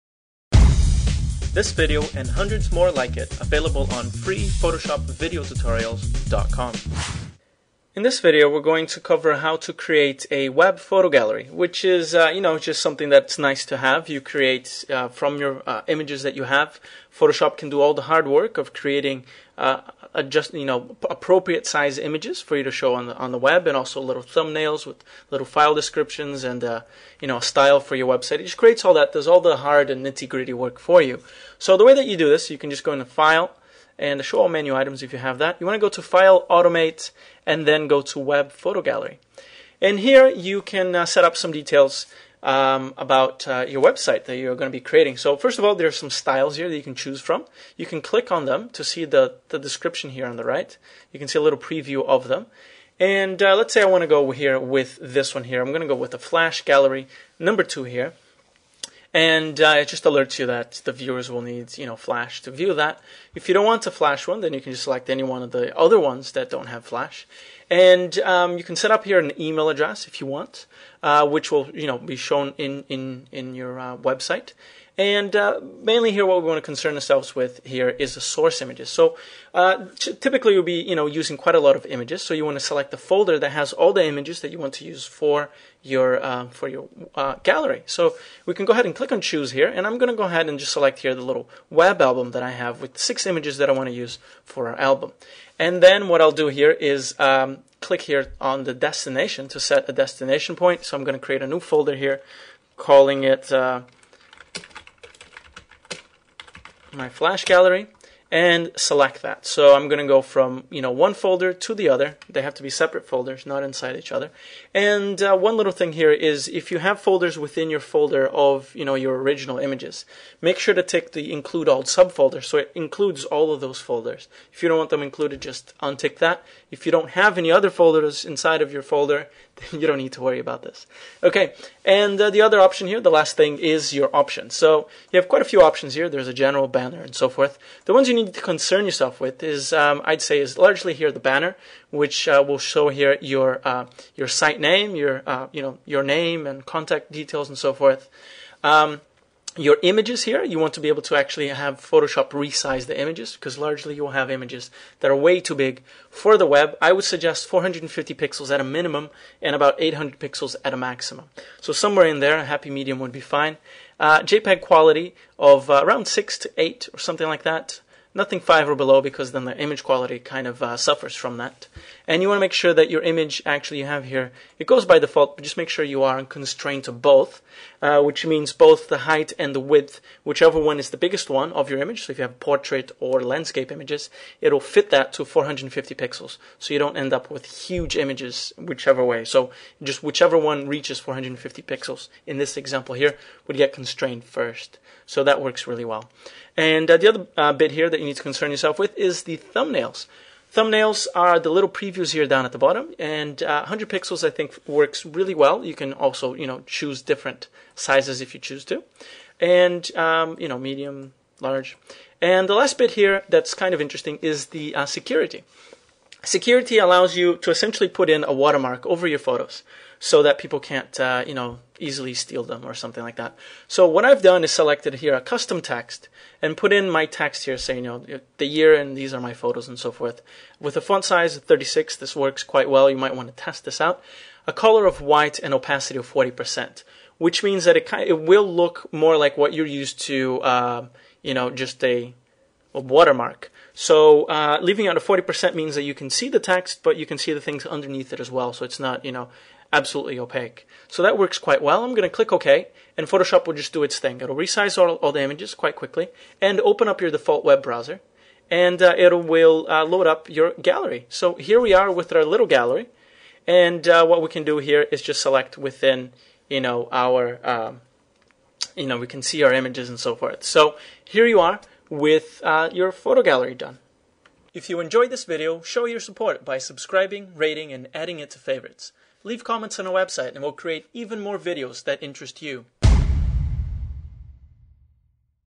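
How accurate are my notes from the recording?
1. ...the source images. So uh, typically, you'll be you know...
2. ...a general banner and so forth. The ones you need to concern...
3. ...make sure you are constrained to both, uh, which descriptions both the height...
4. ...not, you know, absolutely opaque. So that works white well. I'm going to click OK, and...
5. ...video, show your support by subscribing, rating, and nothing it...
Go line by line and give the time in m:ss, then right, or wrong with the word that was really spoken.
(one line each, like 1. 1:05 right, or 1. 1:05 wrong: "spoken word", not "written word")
1. 1:18 right
2. 2:16 right
3. 2:55 wrong: "means", not "descriptions"
4. 4:08 wrong: "quite", not "white"
5. 4:35 wrong: "adding", not "nothing".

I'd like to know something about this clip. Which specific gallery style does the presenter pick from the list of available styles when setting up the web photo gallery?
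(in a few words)
Flash Gallery number two.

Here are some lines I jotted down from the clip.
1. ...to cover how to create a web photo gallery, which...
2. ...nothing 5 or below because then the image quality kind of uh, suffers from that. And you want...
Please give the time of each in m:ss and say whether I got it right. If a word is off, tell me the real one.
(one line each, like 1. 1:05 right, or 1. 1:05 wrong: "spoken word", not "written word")
1. 0:08 right
2. 2:48 right.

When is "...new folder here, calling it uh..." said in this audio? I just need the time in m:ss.
1:41.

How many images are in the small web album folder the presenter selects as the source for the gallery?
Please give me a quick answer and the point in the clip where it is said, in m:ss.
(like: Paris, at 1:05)
6, at 1:32.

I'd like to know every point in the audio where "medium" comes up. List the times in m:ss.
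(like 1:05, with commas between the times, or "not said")
2:42, 3:30.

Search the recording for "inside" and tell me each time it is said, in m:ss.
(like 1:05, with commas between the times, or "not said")
1:53, 2:08.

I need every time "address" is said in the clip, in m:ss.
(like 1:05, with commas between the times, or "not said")
1:09.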